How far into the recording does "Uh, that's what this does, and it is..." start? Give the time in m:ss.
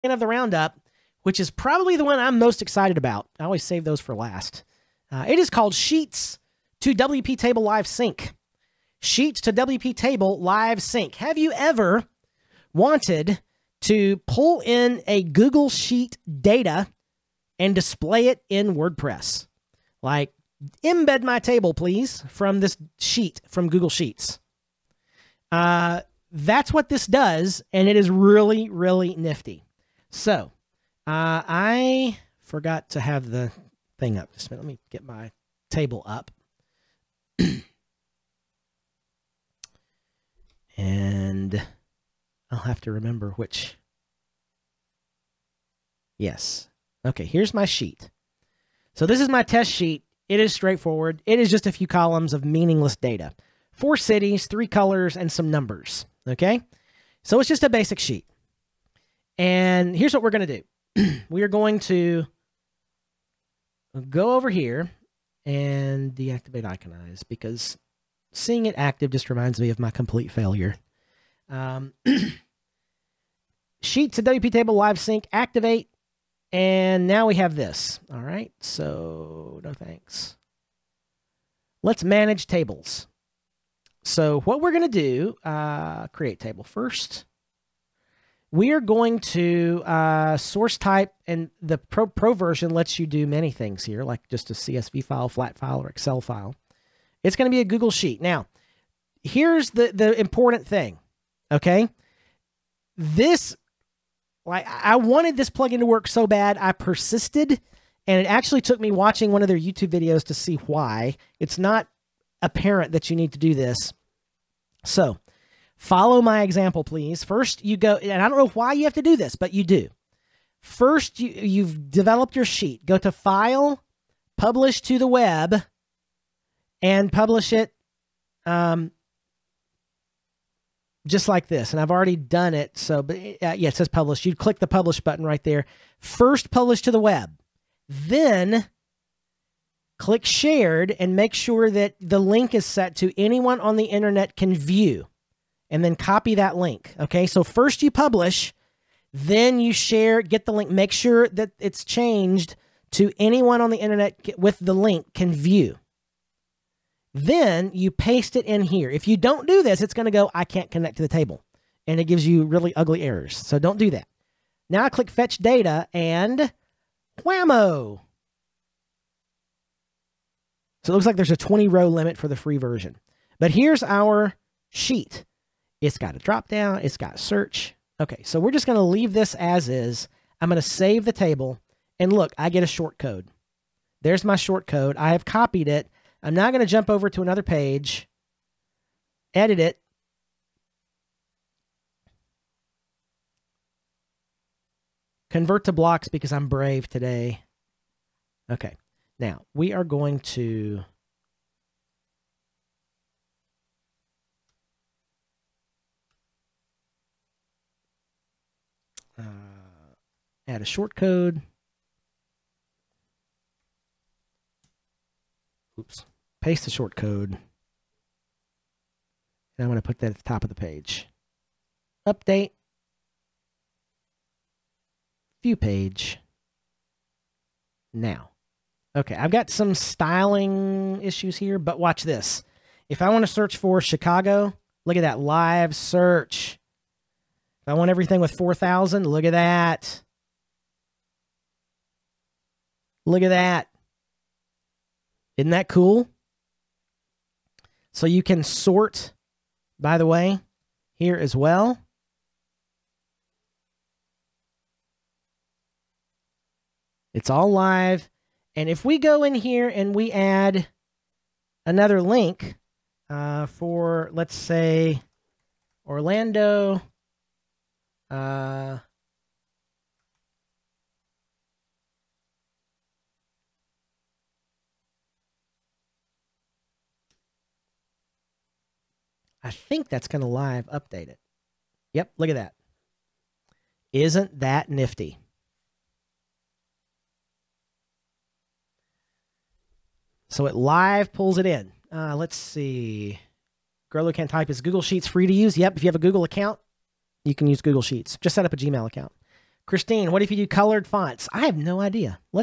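0:25.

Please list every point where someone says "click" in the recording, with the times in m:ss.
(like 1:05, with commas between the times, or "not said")
2:14, 2:19, 2:44.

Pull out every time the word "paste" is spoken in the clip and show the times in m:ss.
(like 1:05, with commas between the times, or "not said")
2:37, 3:36.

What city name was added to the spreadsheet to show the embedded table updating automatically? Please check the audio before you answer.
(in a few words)
Orlando.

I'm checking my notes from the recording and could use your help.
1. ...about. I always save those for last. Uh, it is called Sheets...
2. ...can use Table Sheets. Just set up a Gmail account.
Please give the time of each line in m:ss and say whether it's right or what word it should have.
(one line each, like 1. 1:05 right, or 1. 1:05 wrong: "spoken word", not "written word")
1. 0:02 right
2. 4:57 wrong: "Google", not "Table".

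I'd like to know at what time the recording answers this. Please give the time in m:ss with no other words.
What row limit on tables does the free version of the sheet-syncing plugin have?
2:51.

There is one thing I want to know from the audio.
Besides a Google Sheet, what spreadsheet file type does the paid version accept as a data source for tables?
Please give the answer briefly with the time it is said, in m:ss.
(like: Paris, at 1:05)
Excel file, at 1:35.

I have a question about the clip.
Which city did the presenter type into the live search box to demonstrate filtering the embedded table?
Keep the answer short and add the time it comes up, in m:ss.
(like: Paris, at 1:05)
Chicago, at 3:53.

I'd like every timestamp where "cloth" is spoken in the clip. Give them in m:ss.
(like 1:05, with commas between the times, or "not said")
not said.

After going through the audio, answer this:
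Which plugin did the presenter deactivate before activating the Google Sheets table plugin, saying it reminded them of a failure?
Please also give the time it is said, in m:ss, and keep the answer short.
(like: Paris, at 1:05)
Iconize, at 1:06.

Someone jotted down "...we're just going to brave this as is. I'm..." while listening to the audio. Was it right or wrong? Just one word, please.
wrong.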